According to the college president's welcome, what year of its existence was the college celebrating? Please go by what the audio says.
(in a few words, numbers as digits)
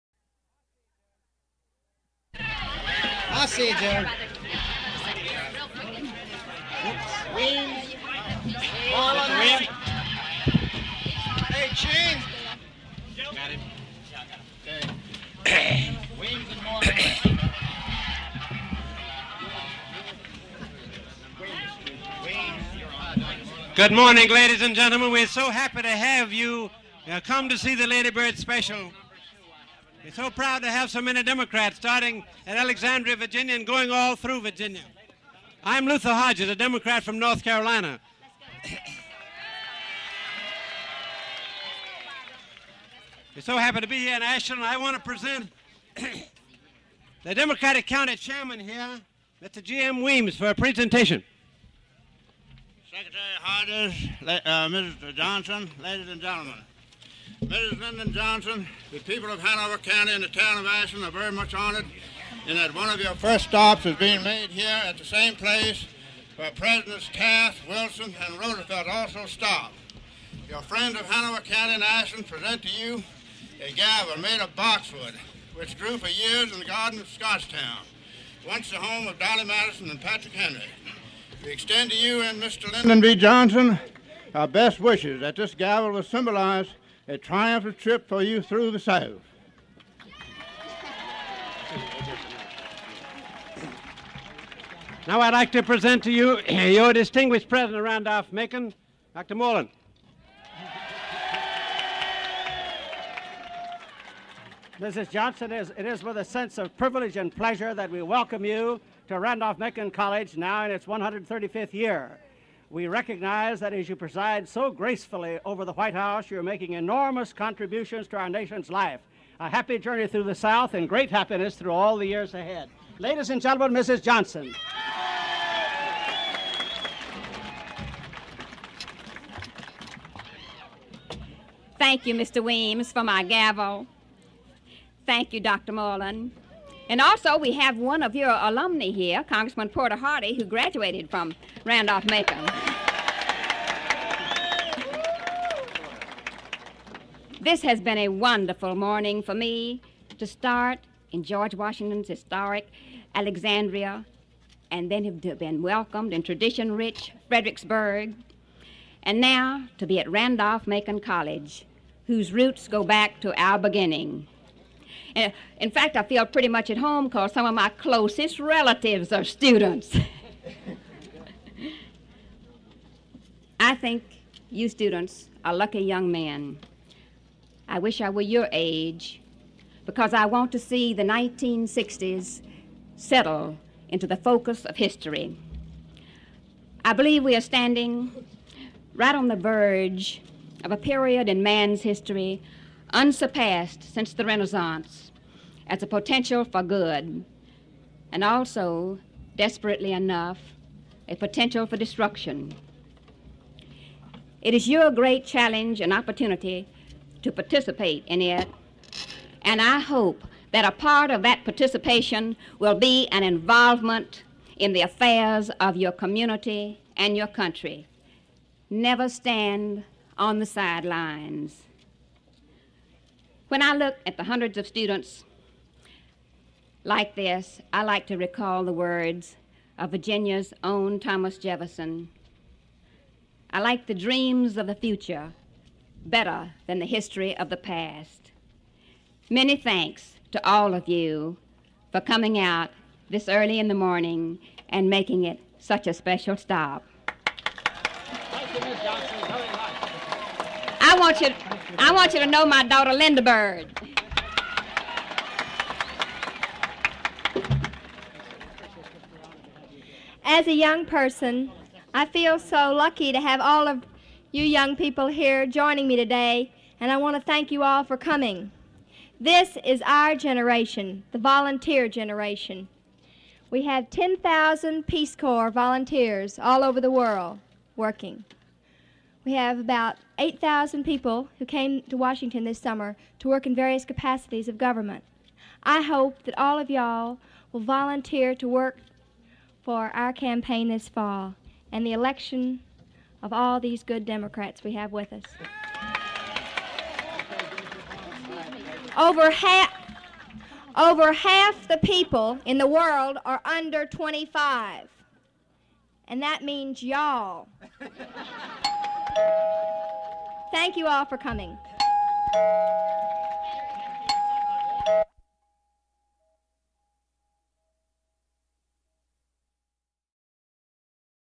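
135th.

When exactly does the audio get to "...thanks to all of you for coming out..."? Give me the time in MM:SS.
03:59.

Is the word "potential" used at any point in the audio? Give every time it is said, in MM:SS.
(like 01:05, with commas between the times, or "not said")
03:15, 03:21.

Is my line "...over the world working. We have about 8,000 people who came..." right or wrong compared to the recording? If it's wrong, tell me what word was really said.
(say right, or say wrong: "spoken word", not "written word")
right.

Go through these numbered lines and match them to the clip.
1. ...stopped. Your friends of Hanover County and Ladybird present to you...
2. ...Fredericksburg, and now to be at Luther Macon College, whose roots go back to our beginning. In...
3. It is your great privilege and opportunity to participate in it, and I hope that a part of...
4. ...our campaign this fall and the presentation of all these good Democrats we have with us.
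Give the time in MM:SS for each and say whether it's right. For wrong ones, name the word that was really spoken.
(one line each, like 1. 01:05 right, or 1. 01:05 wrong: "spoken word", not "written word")
1. 01:09 wrong: "Ashland", not "Ladybird"
2. 02:37 wrong: "Randolph", not "Luther"
3. 03:24 wrong: "challenge", not "privilege"
4. 04:49 wrong: "election", not "presentation".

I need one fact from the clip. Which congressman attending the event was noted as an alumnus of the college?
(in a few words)
Porter Hardy.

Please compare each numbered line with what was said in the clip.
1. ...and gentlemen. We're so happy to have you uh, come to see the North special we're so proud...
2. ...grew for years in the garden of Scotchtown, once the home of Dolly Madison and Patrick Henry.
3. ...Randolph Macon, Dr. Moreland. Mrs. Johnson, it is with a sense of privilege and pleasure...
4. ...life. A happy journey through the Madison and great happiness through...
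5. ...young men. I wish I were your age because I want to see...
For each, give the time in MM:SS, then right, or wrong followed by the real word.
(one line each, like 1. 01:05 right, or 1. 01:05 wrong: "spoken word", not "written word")
1. 00:24 wrong: "Ladybird", not "North"
2. 01:15 right
3. 01:37 right
4. 01:58 wrong: "South", not "Madison"
5. 02:55 right.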